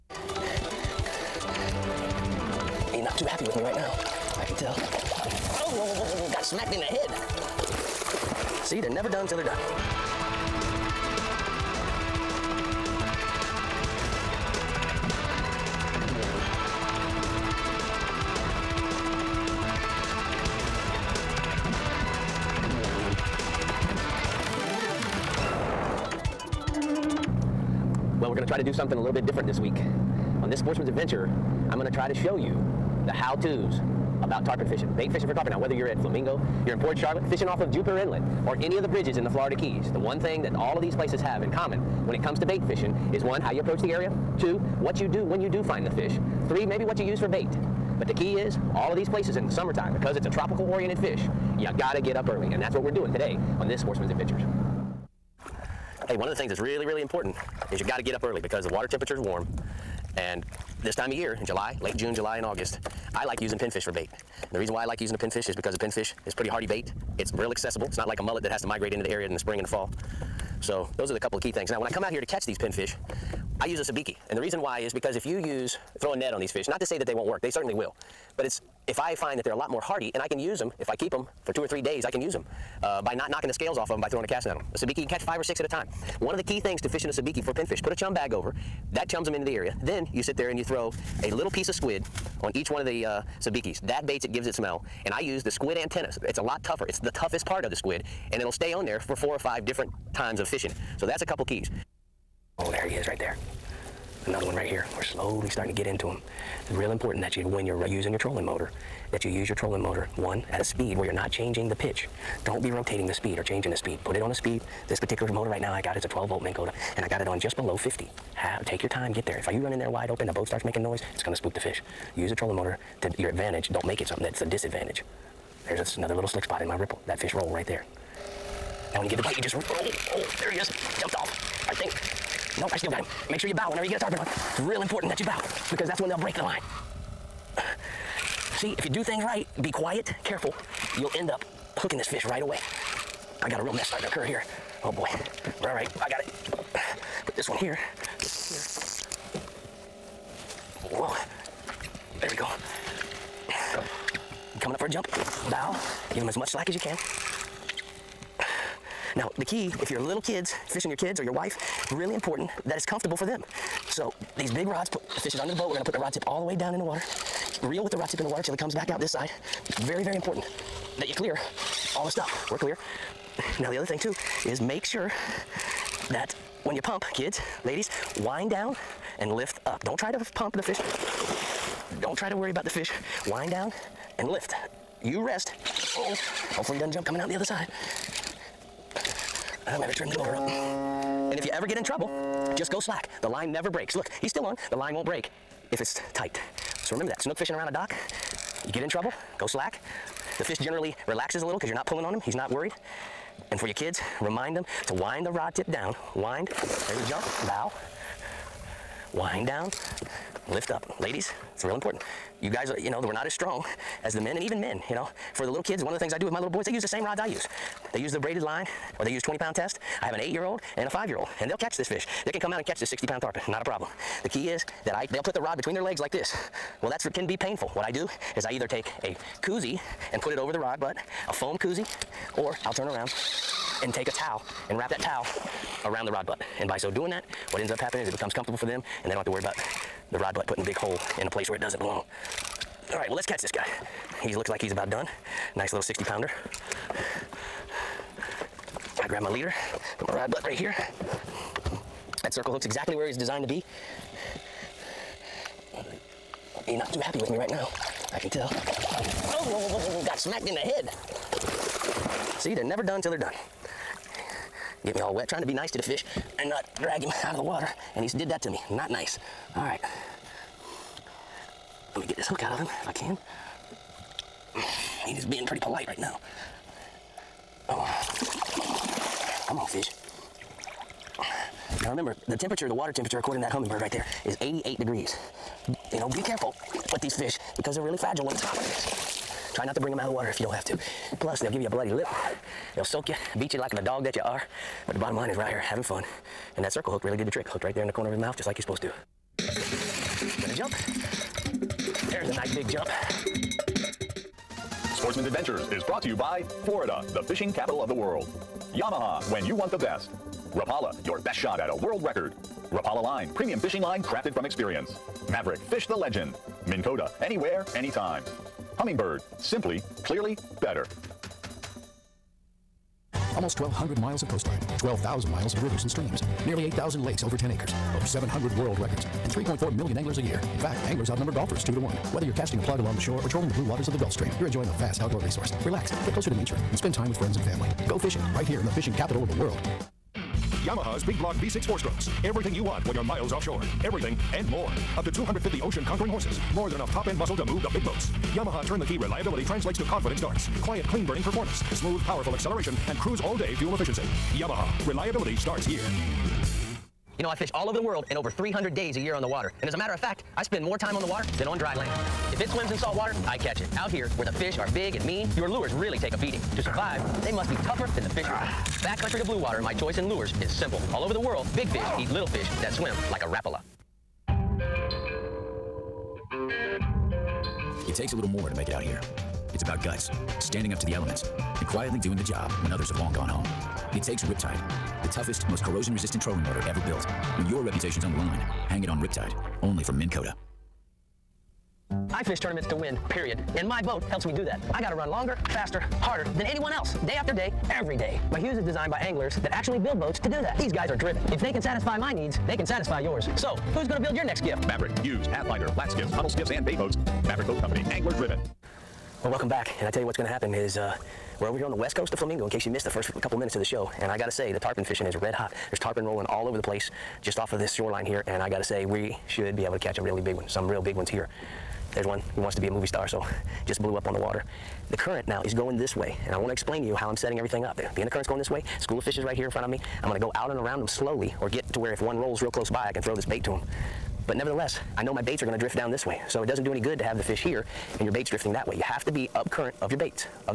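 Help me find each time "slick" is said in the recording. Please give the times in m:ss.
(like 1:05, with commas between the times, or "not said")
2:06.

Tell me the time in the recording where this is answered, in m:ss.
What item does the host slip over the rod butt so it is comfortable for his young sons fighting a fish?
3:51.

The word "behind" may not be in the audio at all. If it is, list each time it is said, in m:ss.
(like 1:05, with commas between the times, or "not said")
not said.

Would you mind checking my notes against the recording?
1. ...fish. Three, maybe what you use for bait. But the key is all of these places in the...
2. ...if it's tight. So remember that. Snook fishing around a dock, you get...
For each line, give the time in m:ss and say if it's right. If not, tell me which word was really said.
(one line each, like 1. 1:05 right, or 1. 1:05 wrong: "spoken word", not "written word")
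1. 0:45 right
2. 3:15 right.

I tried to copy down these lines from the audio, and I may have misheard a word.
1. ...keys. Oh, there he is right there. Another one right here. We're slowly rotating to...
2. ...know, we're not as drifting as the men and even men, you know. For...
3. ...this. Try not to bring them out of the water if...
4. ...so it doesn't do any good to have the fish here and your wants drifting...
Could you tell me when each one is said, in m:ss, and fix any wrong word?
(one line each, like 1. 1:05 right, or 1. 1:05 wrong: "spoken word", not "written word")
1. 1:41 wrong: "starting", not "rotating"
2. 3:32 wrong: "strong", not "drifting"
3. 4:48 right
4. 7:16 wrong: "baits", not "wants".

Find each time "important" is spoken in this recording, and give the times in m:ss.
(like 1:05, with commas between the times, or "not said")
0:57, 1:46, 2:14, 2:42, 2:50, 3:31.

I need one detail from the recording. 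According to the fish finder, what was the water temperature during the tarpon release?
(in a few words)
88 degrees.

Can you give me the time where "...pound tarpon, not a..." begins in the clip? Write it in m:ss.
3:43.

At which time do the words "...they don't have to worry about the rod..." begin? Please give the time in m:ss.
3:59.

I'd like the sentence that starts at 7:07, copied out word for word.
Being the current's going this way, school of fish is right here in front of me.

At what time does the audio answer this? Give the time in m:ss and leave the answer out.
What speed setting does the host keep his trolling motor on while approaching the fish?
1:57.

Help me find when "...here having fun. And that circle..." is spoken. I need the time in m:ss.
4:55.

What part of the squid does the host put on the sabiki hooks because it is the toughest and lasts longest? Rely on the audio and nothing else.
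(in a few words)
squid antennas.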